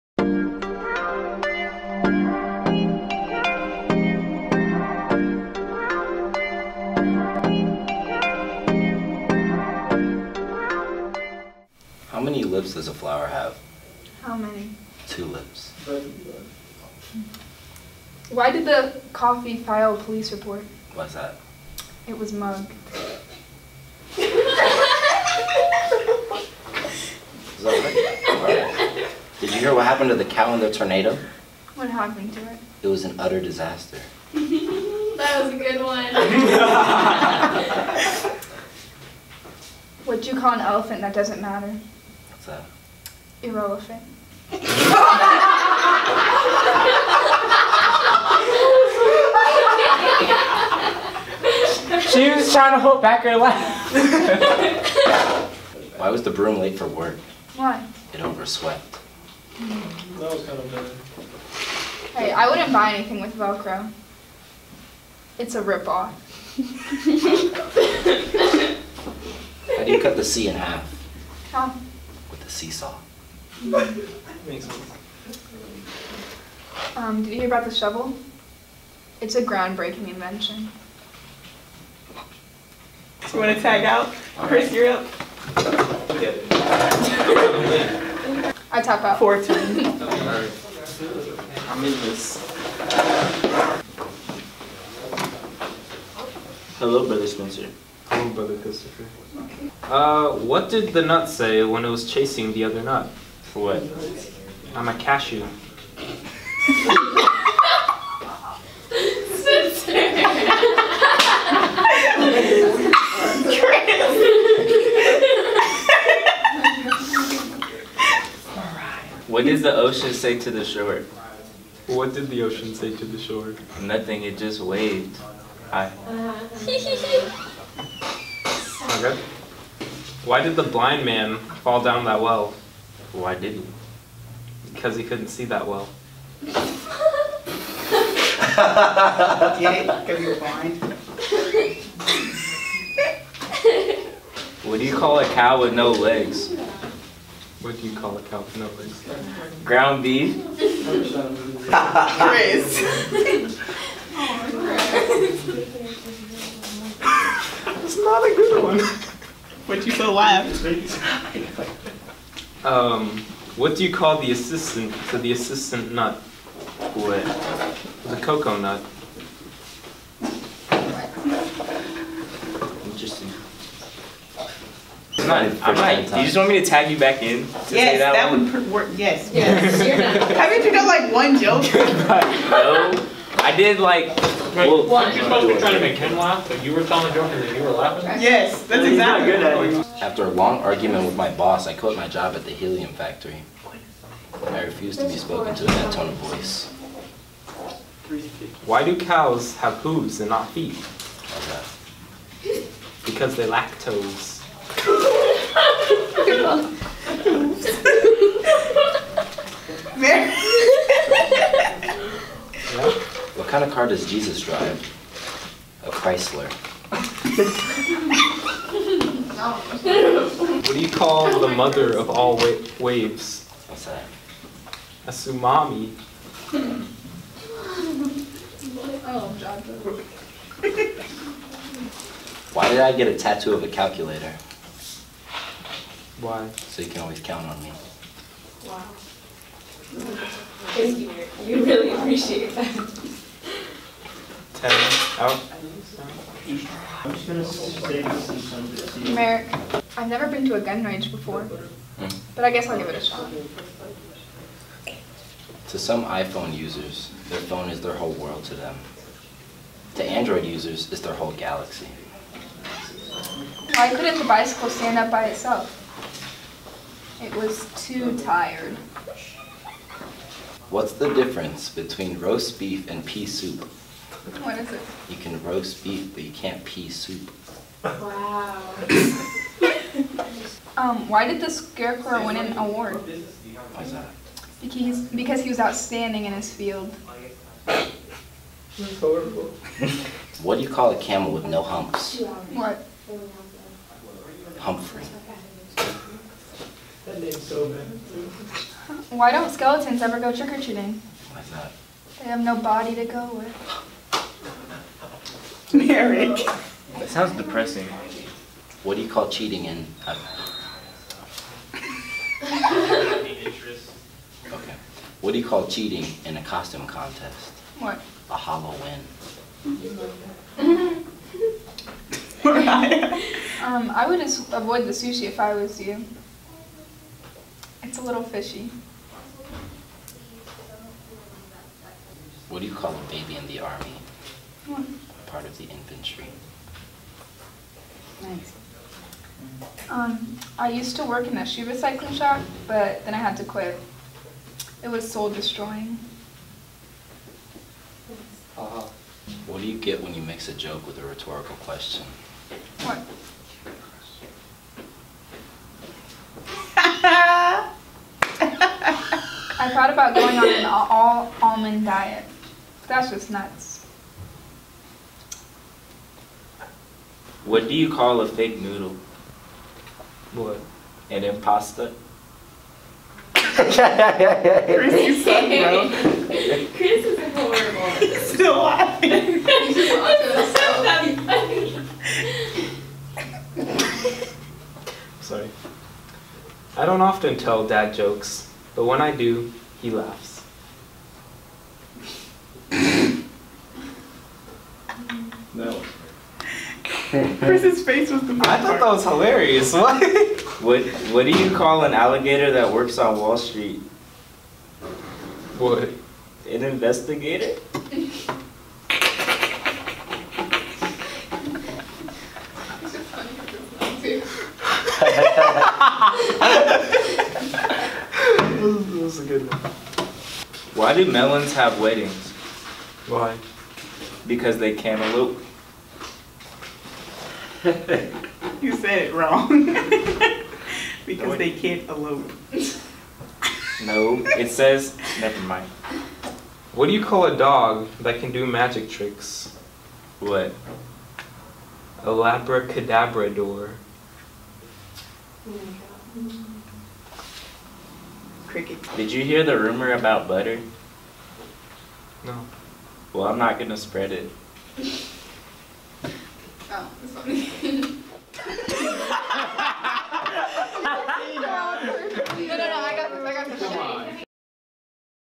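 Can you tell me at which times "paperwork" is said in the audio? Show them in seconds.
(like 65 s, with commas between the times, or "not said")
not said.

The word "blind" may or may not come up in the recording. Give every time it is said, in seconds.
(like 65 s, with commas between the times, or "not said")
130 s, 140 s.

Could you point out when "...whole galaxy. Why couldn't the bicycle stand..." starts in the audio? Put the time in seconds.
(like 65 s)
261 s.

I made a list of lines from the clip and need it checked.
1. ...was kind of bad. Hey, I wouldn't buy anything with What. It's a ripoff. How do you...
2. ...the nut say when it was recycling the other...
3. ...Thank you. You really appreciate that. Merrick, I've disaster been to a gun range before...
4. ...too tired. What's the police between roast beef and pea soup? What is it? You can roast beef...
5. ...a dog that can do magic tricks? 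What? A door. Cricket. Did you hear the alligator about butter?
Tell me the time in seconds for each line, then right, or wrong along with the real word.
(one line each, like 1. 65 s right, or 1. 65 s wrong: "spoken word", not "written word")
1. 60 s wrong: "Velcro", not "What"
2. 100 s wrong: "chasing", not "recycling"
3. 240 s wrong: "never", not "disaster"
4. 267 s wrong: "difference", not "police"
5. 437 s wrong: "rumor", not "alligator".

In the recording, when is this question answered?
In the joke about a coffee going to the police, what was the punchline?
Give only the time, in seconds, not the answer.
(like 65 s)
22 s.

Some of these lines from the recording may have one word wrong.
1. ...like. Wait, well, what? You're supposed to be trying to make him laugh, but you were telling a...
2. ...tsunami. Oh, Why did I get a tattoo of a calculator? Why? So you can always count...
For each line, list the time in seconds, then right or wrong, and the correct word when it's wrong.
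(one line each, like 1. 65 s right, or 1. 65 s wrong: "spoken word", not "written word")
1. 183 s right
2. 225 s right.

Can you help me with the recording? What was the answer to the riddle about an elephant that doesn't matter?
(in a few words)
Irrelevant.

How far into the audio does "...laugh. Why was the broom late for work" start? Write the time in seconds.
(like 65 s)
53 s.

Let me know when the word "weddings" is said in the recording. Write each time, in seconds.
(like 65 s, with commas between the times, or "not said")
421 s.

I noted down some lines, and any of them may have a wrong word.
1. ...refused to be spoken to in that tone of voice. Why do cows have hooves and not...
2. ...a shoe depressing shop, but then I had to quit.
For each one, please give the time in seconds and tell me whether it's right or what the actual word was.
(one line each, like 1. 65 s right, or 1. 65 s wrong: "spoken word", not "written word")
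1. 194 s right
2. 341 s wrong: "recycling", not "depressing".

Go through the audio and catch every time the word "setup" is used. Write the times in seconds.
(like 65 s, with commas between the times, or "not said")
not said.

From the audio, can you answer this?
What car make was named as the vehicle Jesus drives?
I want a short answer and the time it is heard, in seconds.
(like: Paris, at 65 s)
Chrysler, at 215 s.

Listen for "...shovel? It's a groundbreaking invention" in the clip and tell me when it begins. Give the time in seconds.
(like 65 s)
77 s.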